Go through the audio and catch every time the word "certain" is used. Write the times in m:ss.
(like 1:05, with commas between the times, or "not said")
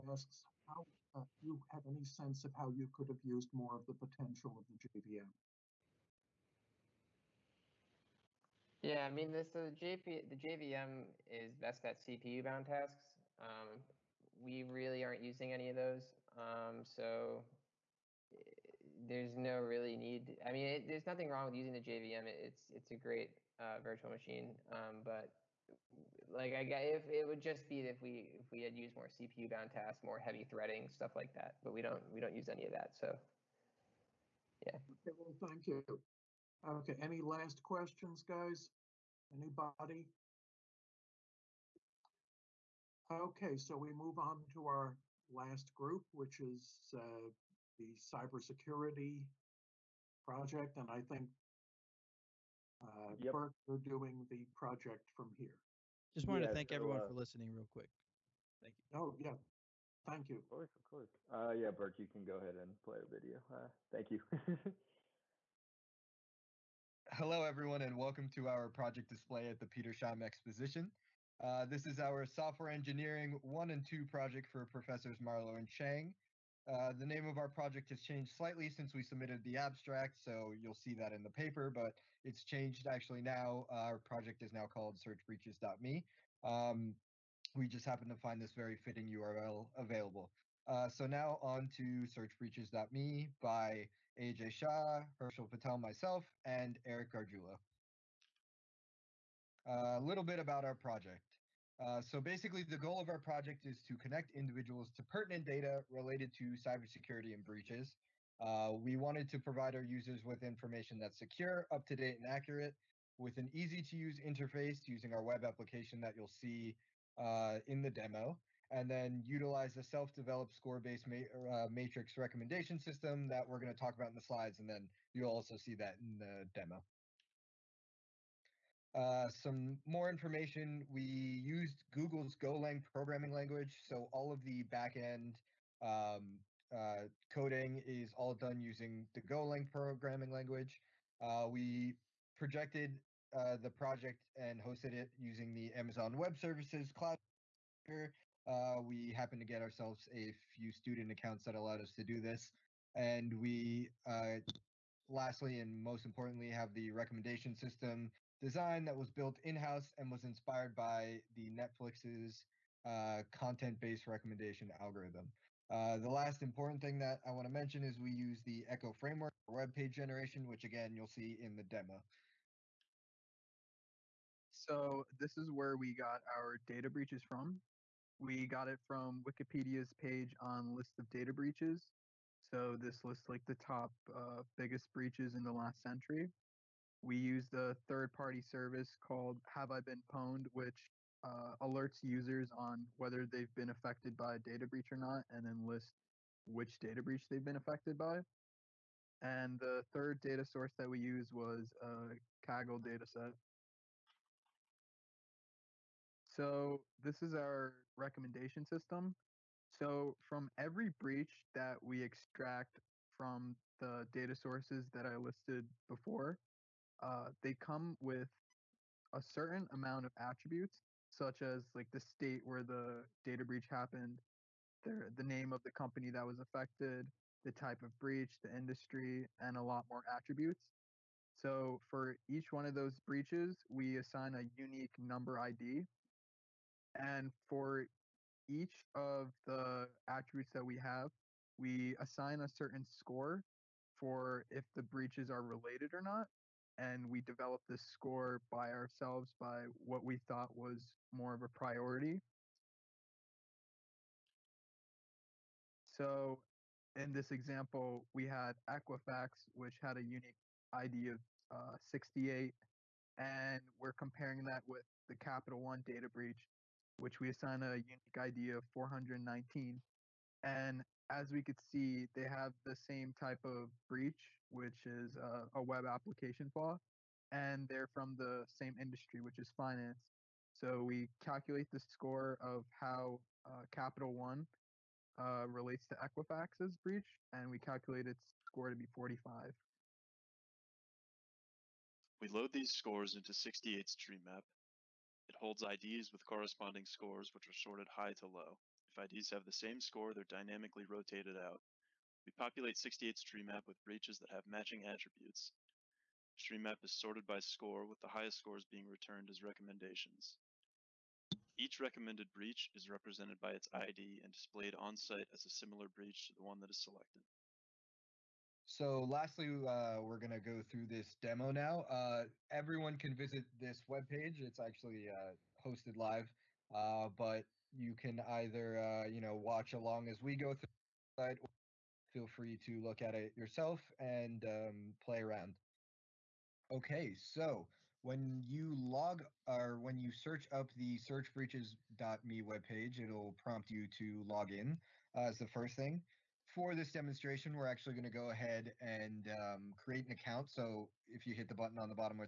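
3:39, 4:02.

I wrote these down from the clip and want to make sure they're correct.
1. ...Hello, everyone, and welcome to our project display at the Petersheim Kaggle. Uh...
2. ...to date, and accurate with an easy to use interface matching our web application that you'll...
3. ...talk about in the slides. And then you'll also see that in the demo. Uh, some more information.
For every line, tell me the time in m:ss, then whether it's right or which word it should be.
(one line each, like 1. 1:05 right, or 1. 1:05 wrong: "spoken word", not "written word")
1. 1:07 wrong: "Exposition", not "Kaggle"
2. 1:51 wrong: "using", not "matching"
3. 2:03 right.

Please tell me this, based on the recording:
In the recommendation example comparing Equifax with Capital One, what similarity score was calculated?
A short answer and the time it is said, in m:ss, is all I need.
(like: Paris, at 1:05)
45, at 4:48.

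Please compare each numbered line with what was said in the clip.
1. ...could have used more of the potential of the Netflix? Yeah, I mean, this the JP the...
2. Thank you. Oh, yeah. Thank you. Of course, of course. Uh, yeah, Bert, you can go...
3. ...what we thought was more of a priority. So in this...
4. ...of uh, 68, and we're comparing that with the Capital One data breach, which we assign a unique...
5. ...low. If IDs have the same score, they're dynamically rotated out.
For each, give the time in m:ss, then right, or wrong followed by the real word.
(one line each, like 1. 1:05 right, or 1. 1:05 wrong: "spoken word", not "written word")
1. 0:02 wrong: "JVM", not "Netflix"
2. 0:58 right
3. 4:09 right
4. 4:21 right
5. 4:58 right.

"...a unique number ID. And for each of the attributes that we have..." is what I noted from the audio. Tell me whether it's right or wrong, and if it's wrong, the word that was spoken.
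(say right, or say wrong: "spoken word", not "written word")
right.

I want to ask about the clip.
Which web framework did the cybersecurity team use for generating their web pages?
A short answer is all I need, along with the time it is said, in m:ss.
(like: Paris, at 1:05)
Echo, at 2:48.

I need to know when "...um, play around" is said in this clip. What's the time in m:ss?
5:34.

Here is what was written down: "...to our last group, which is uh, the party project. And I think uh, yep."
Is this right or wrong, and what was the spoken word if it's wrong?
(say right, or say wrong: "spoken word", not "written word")
wrong: "cybersecurity", not "party".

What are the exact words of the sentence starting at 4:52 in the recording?
We load these scores into 68's tree map.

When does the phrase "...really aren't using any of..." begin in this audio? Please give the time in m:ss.
0:14.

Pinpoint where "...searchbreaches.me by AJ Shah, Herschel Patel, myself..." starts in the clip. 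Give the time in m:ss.
1:32.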